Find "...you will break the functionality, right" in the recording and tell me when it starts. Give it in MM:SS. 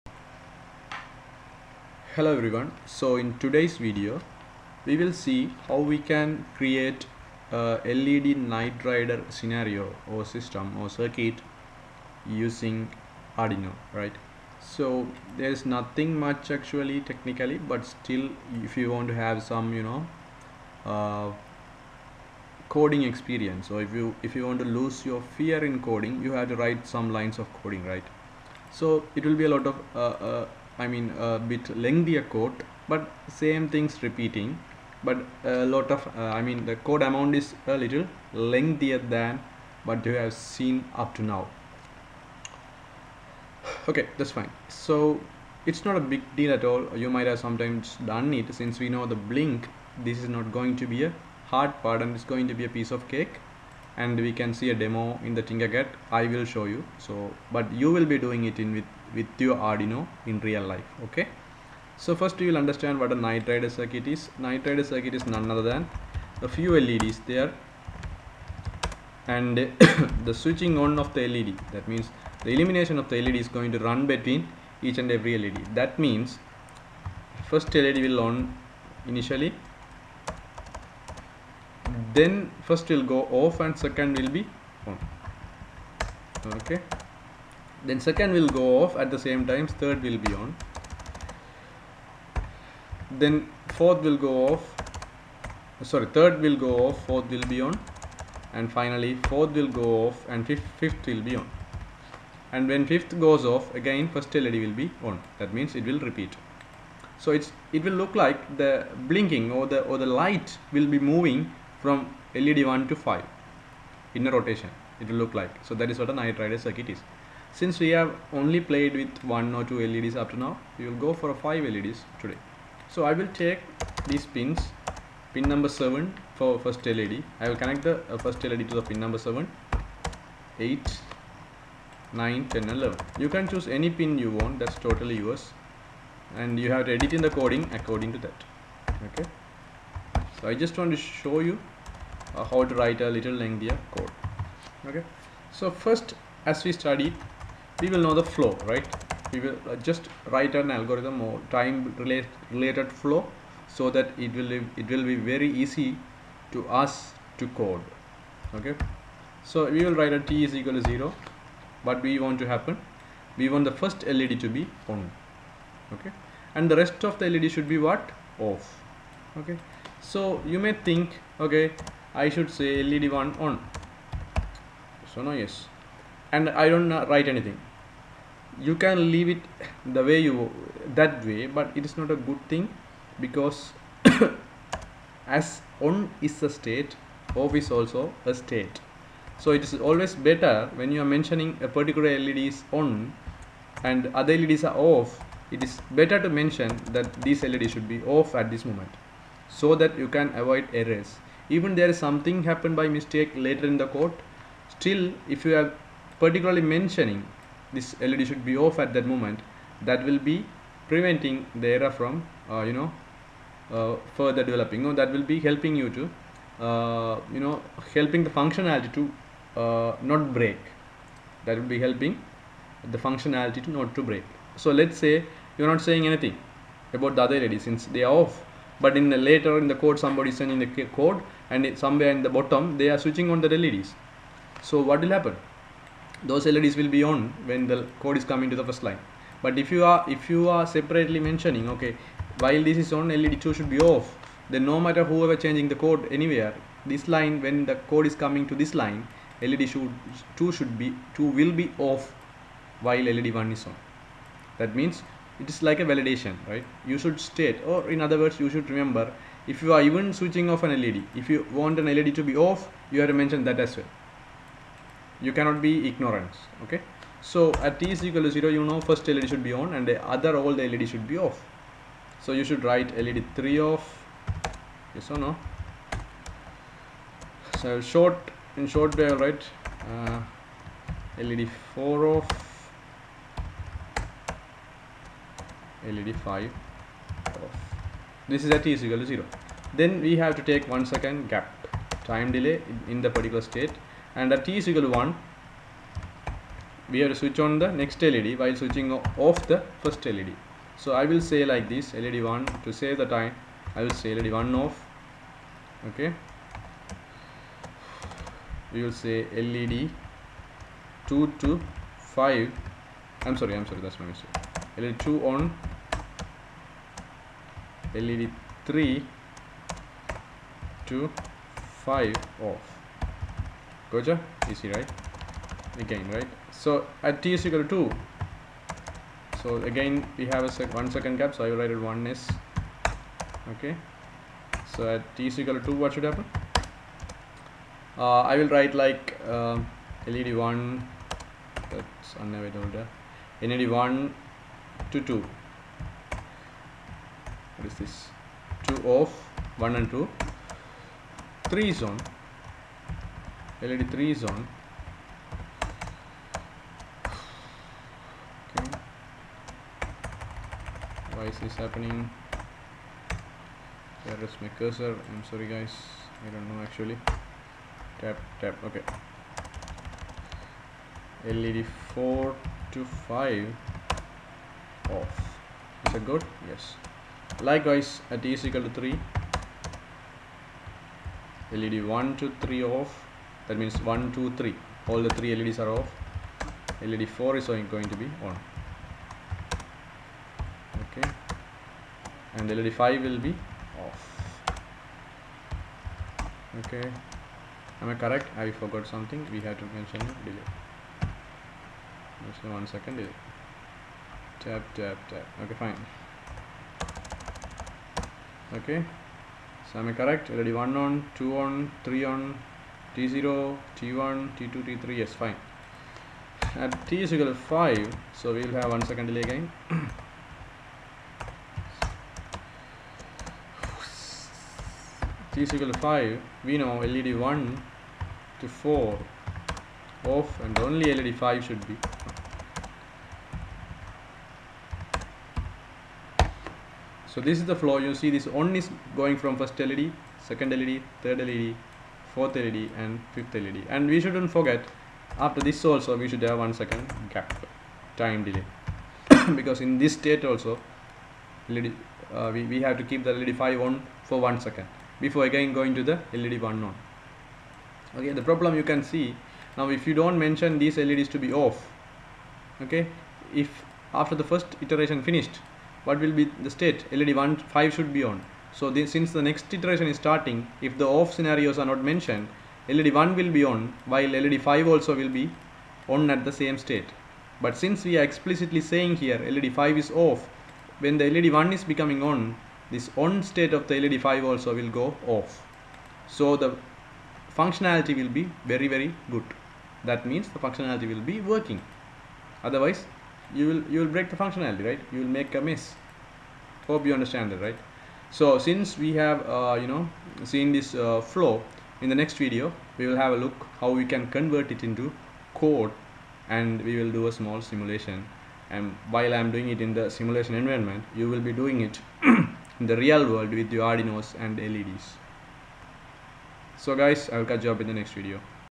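08:13.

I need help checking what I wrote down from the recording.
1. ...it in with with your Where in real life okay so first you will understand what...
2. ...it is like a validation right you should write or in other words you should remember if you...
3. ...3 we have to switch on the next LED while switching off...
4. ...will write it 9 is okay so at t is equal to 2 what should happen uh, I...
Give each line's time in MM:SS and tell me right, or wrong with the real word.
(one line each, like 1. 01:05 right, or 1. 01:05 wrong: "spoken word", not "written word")
1. 00:58 wrong: "Arduino", not "Where"
2. 04:15 wrong: "state", not "write"
3. 04:55 wrong: "1", not "3"
4. 05:31 wrong: "1", not "9".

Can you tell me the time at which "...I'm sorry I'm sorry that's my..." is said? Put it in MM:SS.
05:13.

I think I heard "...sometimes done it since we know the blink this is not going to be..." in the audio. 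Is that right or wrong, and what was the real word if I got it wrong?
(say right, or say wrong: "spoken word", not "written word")
right.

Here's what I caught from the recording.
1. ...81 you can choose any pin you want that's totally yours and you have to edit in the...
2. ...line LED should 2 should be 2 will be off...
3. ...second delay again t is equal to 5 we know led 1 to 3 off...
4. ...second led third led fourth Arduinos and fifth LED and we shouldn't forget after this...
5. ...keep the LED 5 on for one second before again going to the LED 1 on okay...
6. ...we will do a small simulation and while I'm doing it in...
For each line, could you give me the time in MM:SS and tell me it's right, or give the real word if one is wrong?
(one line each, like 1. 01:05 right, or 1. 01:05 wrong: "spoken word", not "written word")
1. 02:12 wrong: "11", not "81"
2. 04:08 right
3. 06:58 wrong: "4", not "3"
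4. 07:20 wrong: "LED", not "Arduinos"
5. 07:32 right
6. 08:26 right.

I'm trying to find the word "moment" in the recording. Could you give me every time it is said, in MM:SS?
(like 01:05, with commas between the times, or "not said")
03:18, 03:29.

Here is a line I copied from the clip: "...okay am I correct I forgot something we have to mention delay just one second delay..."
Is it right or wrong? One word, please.
right.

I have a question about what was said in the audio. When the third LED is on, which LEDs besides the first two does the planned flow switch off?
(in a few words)
LED 4 to 5.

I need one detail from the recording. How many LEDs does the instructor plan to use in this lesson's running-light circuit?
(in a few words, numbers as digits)
5.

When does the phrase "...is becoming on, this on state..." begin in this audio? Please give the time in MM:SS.
08:01.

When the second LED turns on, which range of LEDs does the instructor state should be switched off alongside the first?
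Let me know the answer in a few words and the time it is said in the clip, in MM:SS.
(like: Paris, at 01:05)
LED 3 to 5, at 05:17.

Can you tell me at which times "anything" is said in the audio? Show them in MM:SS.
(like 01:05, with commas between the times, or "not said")
02:57, 03:46.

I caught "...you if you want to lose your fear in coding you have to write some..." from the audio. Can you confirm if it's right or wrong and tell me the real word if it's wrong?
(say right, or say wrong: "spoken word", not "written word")
right.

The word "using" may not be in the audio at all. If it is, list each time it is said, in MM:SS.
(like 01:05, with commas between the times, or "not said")
00:12.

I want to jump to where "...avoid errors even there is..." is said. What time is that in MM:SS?
03:20.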